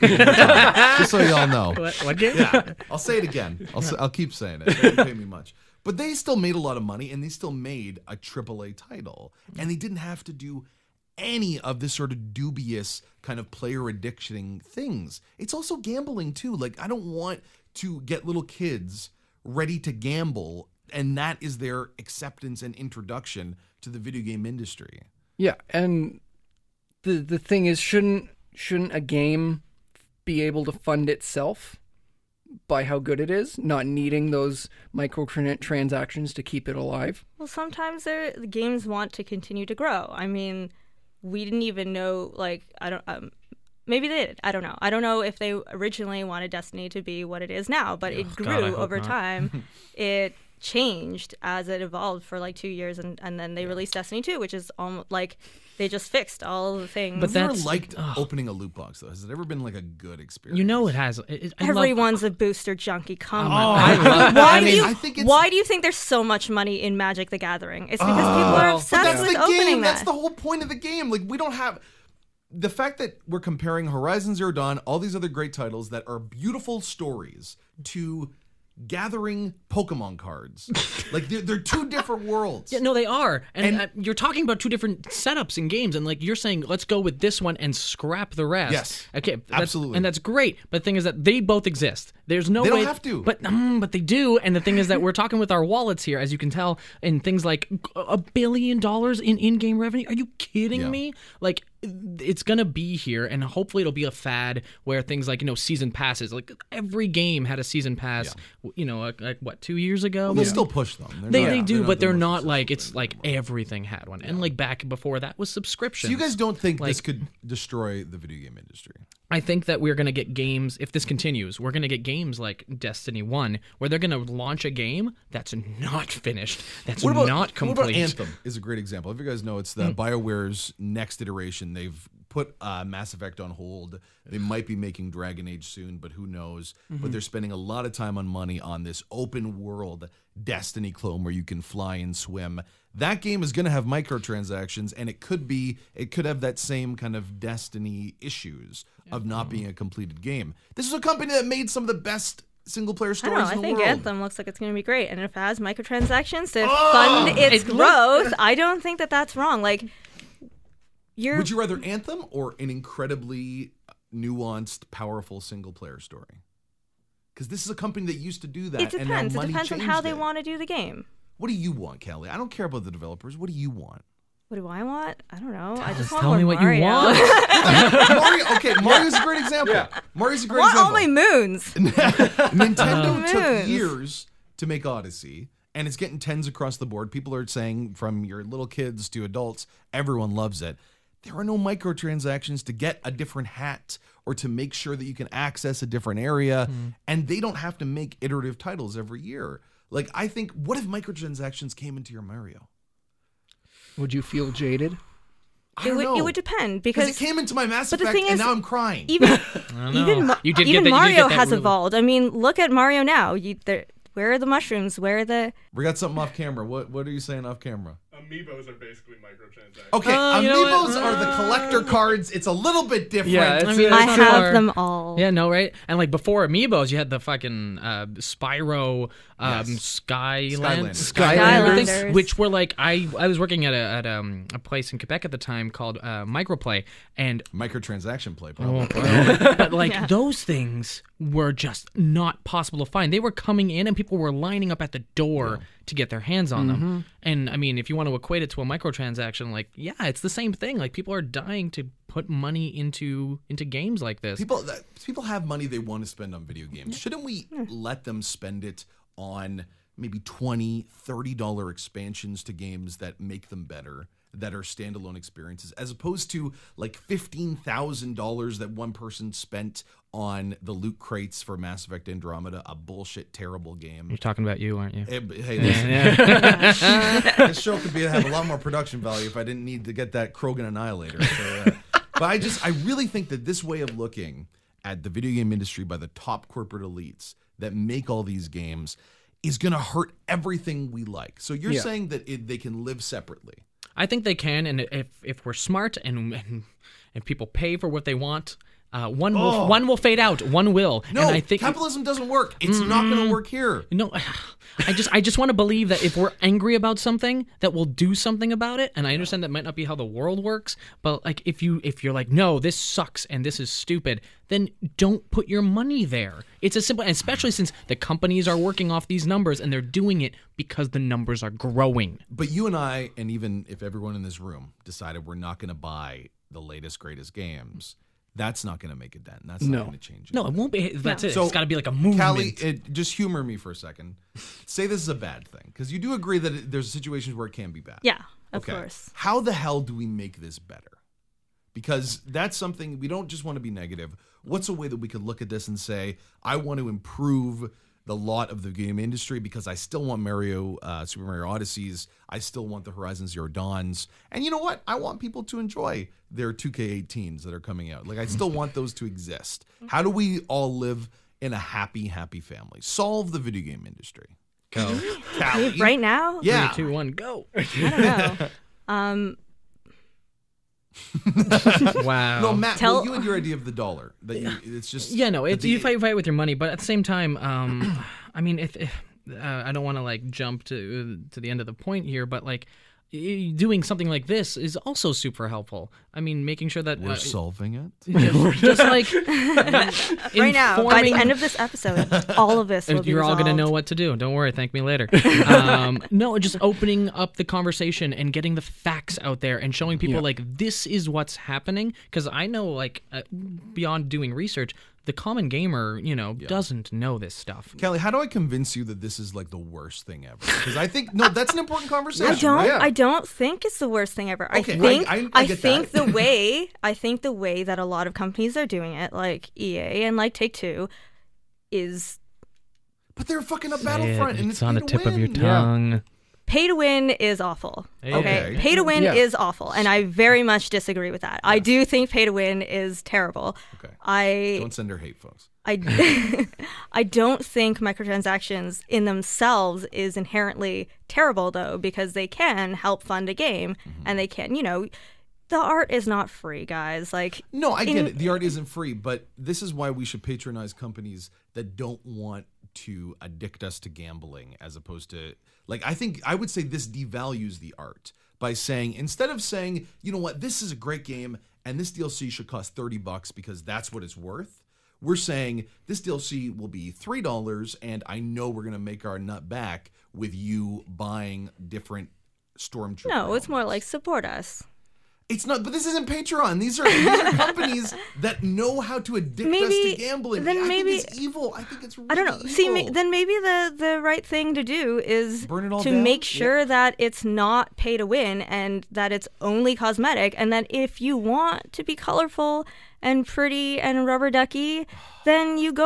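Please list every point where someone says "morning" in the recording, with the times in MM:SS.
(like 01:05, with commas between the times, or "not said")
not said.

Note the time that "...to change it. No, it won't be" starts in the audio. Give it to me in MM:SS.
05:29.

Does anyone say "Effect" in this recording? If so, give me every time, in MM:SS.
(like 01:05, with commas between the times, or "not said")
02:13, 03:27, 04:31.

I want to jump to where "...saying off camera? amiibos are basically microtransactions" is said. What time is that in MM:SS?
03:37.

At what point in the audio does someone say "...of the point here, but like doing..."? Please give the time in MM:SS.
06:21.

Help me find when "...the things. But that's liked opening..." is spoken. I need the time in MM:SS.
00:56.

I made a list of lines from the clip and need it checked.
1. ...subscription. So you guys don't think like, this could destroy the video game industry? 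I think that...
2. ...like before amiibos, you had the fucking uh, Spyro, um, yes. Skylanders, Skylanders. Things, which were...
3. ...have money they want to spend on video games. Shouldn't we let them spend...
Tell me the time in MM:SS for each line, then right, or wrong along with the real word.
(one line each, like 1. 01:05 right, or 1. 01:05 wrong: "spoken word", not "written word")
1. 01:55 right
2. 03:45 right
3. 04:15 right.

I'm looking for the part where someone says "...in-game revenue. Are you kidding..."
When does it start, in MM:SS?
01:39.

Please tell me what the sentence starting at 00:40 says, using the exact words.
I mean, we didn't even know like I don't.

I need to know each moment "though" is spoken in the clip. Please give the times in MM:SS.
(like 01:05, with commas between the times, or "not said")
00:59, 07:21.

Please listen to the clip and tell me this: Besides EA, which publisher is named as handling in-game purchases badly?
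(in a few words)
Take Two.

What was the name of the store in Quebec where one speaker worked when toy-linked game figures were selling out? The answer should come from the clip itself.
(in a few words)
Microplay.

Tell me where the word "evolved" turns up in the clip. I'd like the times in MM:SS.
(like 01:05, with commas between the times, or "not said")
00:51, 03:31.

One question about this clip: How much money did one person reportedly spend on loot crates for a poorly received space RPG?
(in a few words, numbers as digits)
$15,000.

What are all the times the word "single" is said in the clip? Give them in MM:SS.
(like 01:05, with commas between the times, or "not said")
02:32, 02:45.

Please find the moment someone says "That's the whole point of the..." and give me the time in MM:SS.
01:09.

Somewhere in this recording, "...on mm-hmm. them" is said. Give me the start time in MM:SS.
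04:06.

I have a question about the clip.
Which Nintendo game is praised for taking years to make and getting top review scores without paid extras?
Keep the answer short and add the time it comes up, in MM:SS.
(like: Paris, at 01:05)
Odyssey, at 03:04.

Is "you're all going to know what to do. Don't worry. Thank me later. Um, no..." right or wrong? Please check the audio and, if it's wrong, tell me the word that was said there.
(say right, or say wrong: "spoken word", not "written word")
right.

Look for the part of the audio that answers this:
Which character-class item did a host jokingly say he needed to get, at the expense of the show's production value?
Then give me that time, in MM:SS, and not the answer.
04:40.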